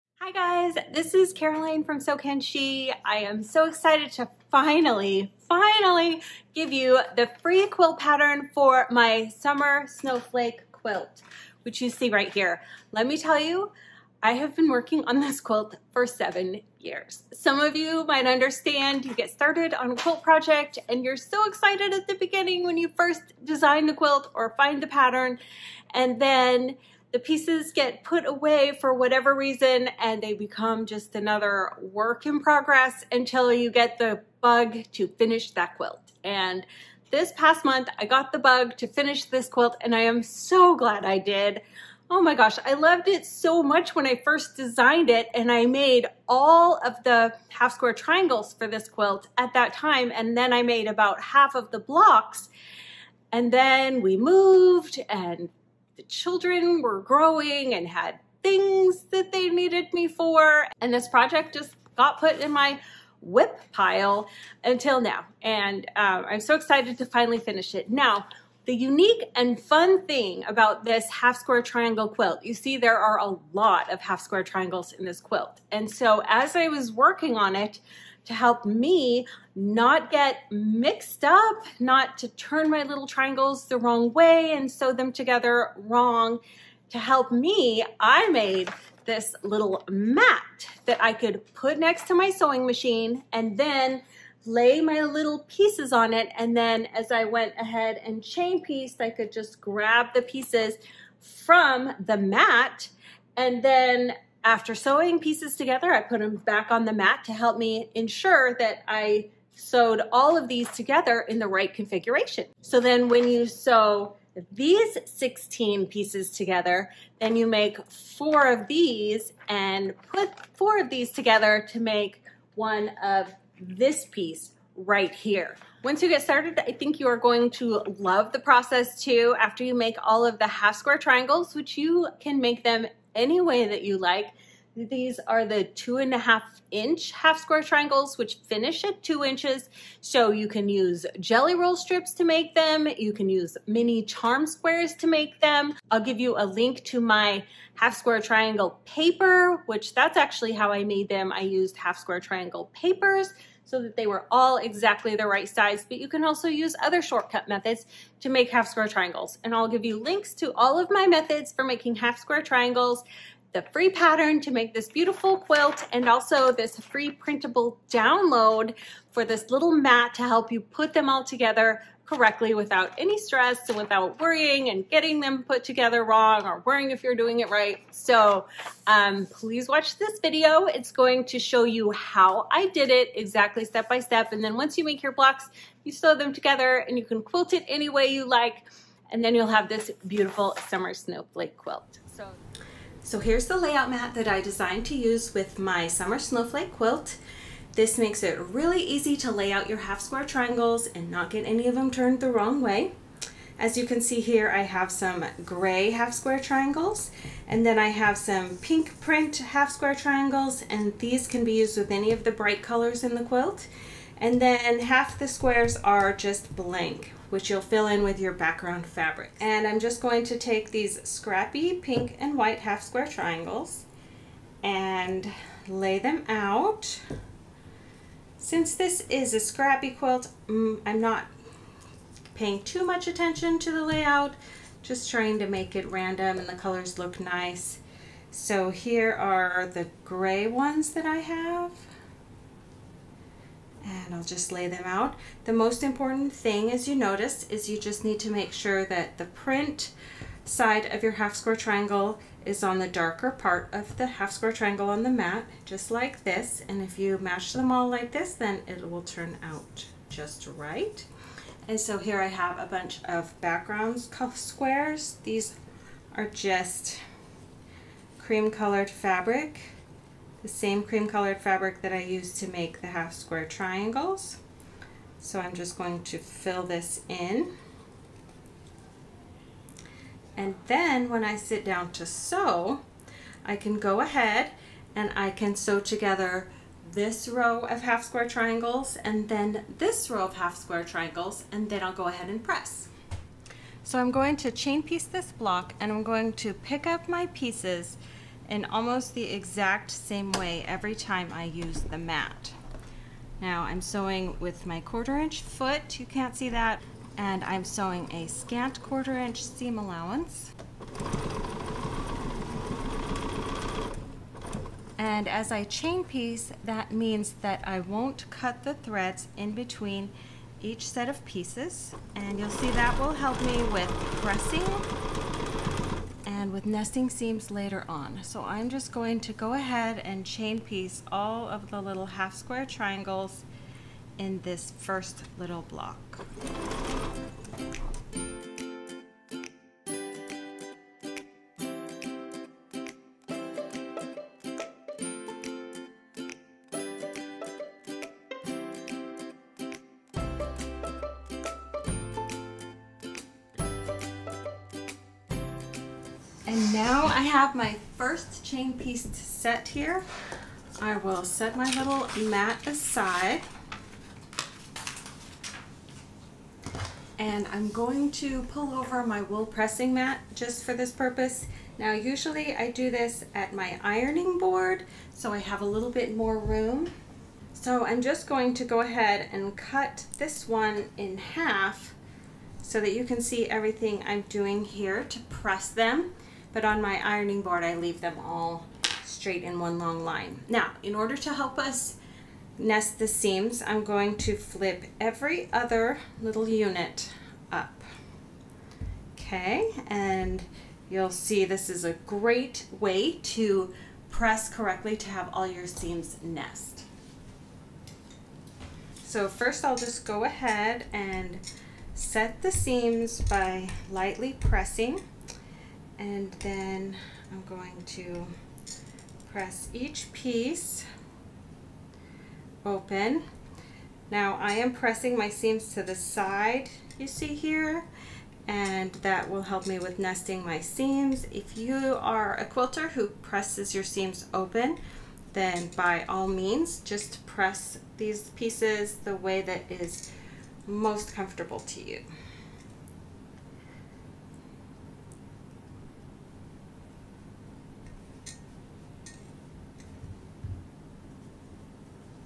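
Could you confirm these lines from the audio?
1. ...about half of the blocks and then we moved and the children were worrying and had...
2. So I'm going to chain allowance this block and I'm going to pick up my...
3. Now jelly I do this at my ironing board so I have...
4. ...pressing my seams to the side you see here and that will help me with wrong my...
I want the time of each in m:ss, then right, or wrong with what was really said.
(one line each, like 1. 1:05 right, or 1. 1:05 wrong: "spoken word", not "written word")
1. 0:50 wrong: "growing", not "worrying"
2. 4:53 wrong: "piece", not "allowance"
3. 6:11 wrong: "usually", not "jelly"
4. 7:04 wrong: "nesting", not "wrong".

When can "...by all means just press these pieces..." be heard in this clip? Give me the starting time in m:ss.
7:15.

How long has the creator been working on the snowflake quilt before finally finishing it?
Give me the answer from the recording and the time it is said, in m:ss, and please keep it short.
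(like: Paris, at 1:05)
7 years, at 0:16.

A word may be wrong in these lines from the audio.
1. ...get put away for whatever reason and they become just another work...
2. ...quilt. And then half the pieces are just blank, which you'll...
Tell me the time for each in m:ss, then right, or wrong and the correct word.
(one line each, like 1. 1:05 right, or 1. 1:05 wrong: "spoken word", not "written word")
1. 0:27 right
2. 3:33 wrong: "squares", not "pieces".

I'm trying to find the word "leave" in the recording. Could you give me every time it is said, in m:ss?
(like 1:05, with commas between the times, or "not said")
6:27.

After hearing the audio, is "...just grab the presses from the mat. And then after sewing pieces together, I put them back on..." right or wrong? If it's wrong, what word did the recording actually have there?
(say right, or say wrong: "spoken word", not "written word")
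wrong: "pieces", not "presses".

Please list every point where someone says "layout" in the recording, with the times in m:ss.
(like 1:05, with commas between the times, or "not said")
3:13, 3:53.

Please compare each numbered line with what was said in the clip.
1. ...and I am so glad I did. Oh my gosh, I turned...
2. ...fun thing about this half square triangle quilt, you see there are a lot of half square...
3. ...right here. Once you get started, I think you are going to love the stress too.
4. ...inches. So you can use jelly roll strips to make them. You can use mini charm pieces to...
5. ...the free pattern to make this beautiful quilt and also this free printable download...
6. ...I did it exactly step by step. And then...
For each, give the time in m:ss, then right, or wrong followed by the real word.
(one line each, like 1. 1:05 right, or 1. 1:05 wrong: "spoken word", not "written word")
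1. 0:39 wrong: "loved", not "turned"
2. 1:09 right
3. 2:04 wrong: "process", not "stress"
4. 2:19 wrong: "squares", not "pieces"
5. 2:43 right
6. 3:02 right.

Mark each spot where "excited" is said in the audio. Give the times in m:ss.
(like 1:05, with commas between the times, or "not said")
0:03, 0:21, 1:06.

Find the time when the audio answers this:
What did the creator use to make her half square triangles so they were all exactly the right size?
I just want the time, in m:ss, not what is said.
2:31.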